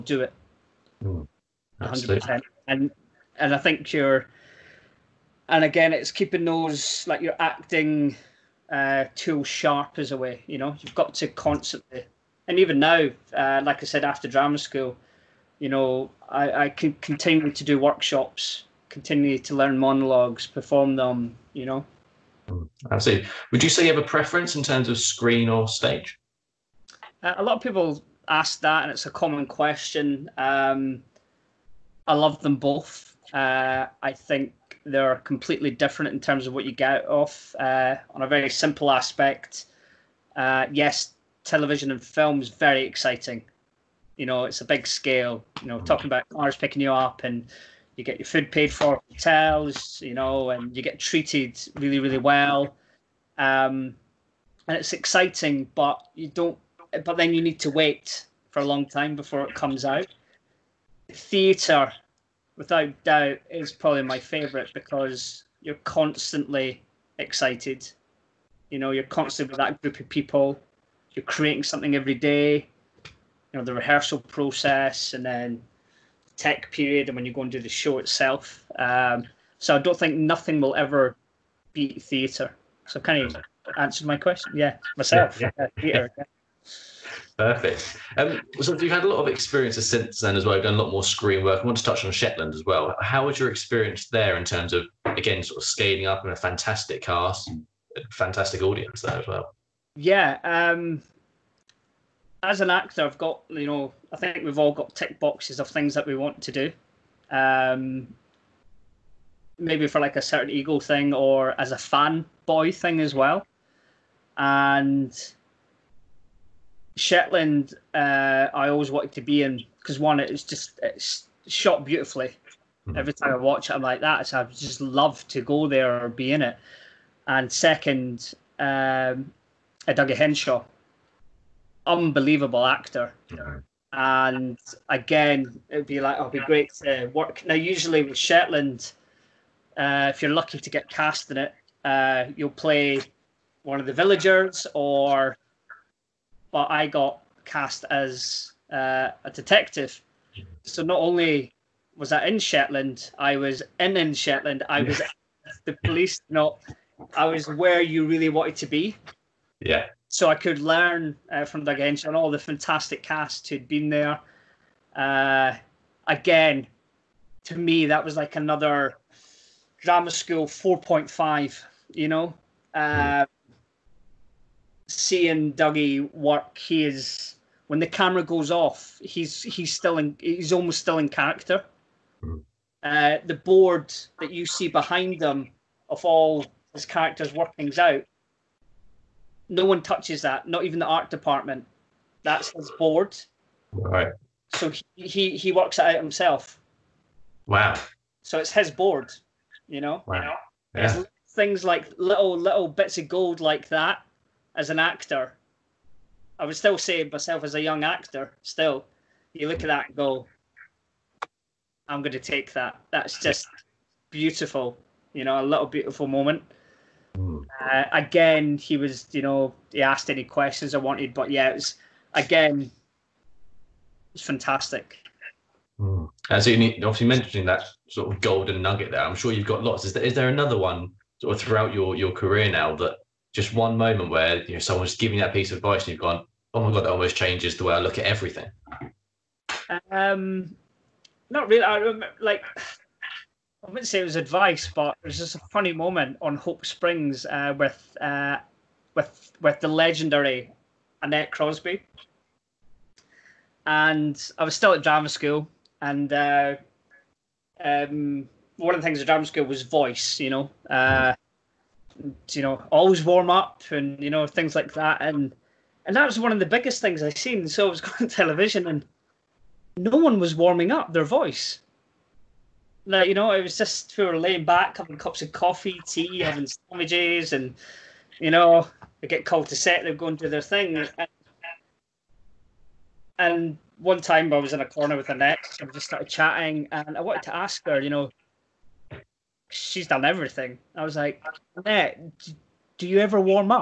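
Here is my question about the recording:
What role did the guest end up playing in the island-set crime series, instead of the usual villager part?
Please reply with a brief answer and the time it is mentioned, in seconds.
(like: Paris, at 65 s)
a detective, at 149 s.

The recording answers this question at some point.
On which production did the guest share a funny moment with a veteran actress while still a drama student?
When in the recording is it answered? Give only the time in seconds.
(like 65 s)
246 s.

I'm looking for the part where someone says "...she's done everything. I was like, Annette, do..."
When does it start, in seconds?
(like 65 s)
289 s.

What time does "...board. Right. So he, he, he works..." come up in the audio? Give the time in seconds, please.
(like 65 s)
192 s.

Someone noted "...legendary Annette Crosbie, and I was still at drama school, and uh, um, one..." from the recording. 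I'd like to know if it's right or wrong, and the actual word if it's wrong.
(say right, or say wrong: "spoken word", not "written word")
right.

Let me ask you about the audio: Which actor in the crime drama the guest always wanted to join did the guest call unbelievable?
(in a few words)
Douglas Henshall.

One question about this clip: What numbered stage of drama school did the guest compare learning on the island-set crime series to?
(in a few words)
drama school 4.5.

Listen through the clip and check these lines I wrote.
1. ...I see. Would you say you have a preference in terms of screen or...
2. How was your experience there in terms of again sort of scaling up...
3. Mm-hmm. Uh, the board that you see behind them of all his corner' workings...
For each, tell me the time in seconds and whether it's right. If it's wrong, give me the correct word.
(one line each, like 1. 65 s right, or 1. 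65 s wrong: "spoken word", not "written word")
1. 22 s right
2. 92 s right
3. 182 s wrong: "characters", not "corner".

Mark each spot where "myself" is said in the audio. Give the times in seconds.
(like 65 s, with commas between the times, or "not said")
84 s, 207 s.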